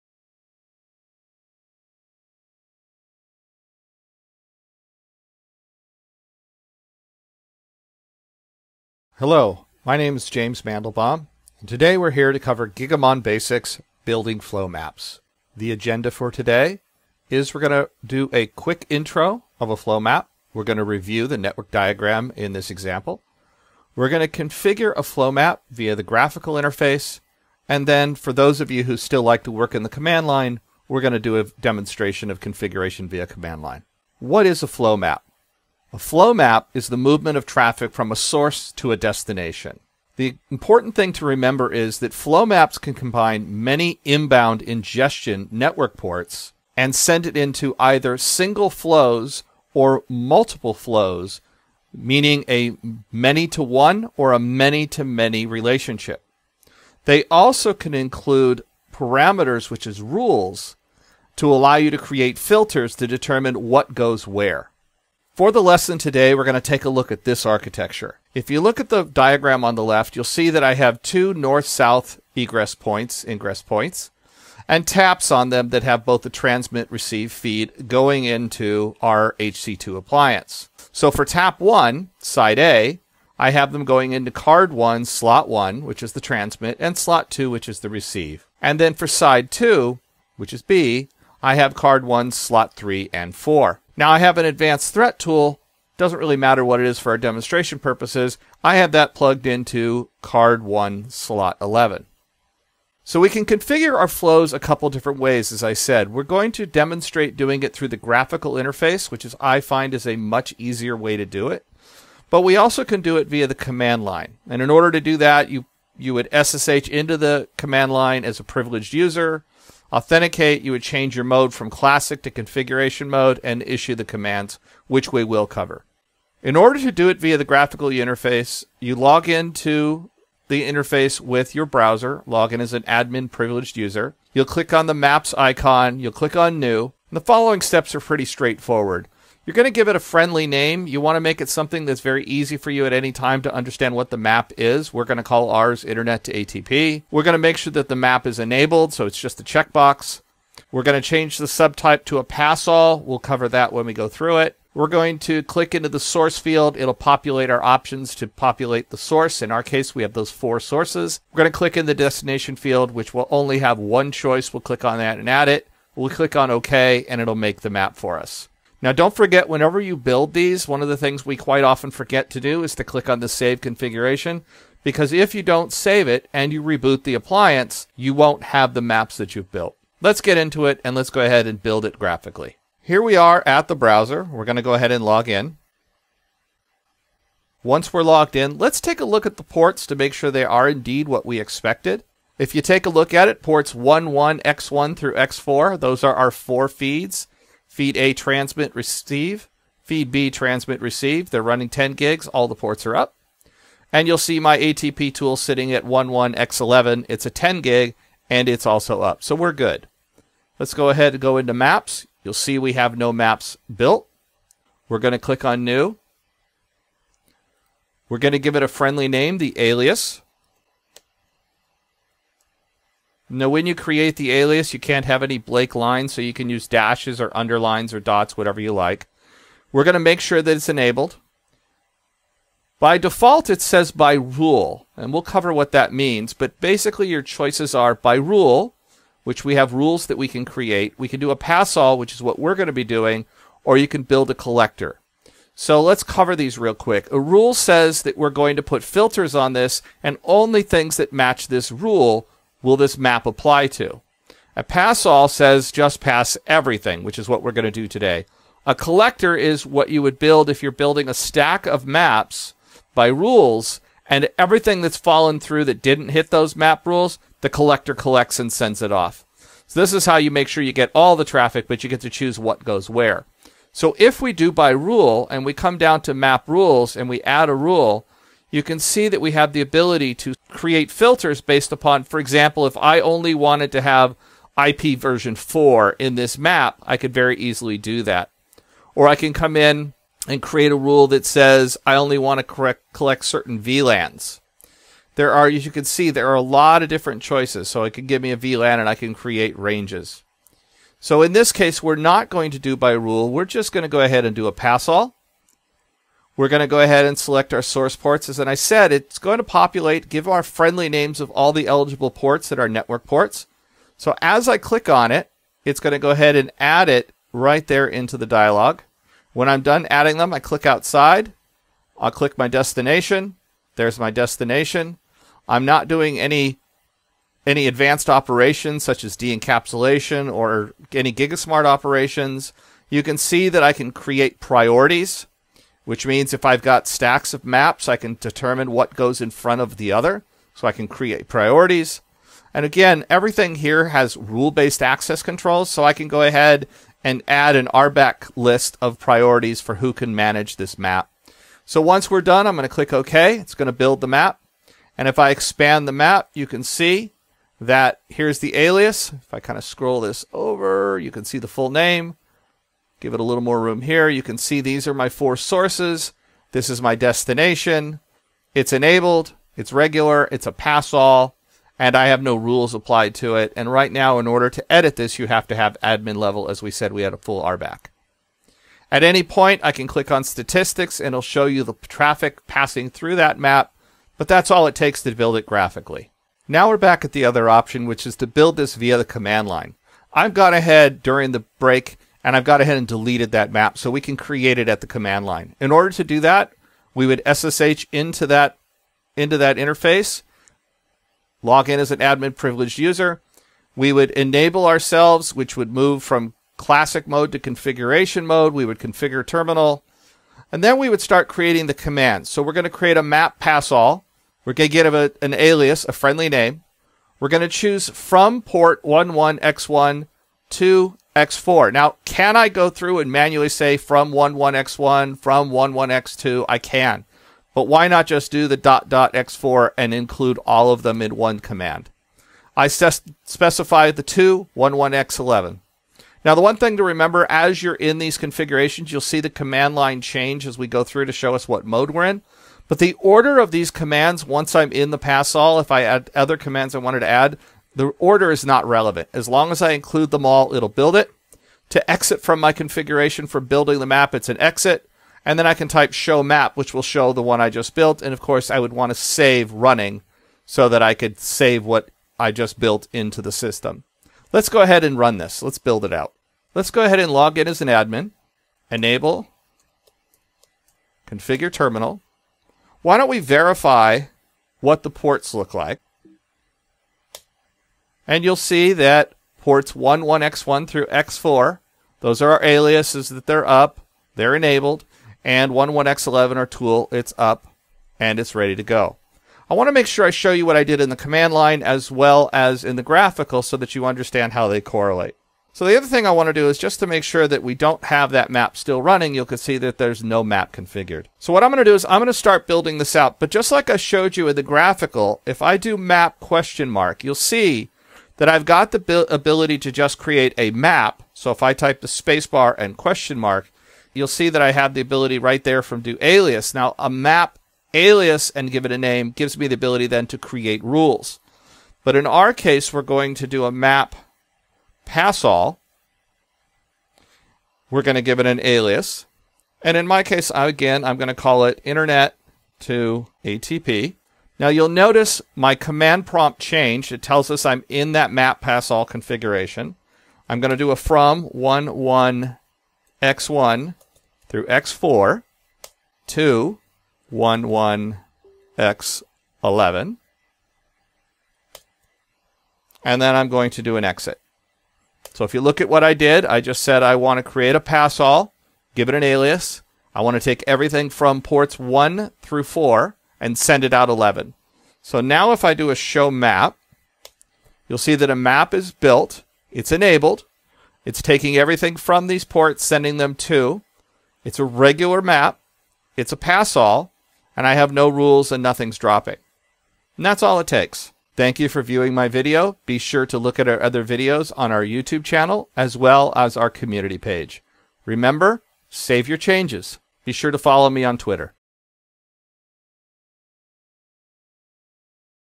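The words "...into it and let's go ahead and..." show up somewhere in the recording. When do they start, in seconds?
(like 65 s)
180 s.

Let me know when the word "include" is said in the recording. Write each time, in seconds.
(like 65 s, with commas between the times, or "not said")
57 s, 429 s, 449 s.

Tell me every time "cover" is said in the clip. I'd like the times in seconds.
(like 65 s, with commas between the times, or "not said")
12 s, 125 s, 153 s, 235 s, 246 s.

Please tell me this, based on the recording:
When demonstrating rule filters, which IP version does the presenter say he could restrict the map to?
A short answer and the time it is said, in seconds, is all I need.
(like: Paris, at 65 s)
IP version 4, at 284 s.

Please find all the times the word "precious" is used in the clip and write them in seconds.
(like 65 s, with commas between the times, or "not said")
not said.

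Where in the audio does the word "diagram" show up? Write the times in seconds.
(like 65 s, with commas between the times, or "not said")
21 s, 69 s.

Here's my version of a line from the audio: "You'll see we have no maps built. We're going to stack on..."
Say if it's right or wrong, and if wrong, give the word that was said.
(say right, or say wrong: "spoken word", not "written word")
wrong: "click", not "stack".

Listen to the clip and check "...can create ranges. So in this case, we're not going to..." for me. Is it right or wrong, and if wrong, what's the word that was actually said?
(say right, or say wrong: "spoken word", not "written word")
right.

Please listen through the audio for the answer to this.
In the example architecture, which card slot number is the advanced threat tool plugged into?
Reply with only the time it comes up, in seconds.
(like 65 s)
101 s.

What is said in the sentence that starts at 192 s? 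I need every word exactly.
If you take a look at it, ports 11, X1 through X4, those are our four feeds.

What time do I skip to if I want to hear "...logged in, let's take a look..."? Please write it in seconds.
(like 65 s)
188 s.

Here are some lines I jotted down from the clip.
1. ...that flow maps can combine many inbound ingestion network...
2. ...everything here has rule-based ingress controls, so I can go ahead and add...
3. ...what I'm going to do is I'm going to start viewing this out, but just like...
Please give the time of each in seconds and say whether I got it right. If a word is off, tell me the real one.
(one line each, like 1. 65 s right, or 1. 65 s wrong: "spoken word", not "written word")
1. 41 s right
2. 343 s wrong: "access", not "ingress"
3. 501 s wrong: "building", not "viewing".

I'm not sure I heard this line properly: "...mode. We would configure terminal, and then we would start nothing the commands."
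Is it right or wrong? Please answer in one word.
wrong.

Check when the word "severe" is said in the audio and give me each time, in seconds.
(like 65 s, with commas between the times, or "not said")
not said.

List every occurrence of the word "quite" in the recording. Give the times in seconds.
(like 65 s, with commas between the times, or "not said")
171 s.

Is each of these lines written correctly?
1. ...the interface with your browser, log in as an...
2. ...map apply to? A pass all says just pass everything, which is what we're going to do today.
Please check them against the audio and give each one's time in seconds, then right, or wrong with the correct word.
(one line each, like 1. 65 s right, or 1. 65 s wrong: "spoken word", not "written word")
1. 130 s right
2. 252 s right.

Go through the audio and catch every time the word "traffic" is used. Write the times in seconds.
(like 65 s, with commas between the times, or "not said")
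37 s, 271 s, 381 s.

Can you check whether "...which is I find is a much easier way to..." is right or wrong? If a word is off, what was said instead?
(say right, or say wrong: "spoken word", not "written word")
right.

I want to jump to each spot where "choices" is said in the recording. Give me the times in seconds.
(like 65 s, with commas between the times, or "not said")
164 s, 237 s, 297 s.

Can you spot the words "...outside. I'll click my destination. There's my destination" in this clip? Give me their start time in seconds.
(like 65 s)
320 s.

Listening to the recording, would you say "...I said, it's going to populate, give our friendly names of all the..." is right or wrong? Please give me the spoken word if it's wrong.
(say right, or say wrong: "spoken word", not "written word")
right.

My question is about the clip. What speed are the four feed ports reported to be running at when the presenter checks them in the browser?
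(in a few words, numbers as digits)
10 gigs.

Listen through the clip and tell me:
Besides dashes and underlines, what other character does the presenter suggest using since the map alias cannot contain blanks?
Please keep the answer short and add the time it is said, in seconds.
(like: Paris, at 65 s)
dots, at 228 s.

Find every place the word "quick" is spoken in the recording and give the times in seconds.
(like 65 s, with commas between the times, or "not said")
18 s, 246 s.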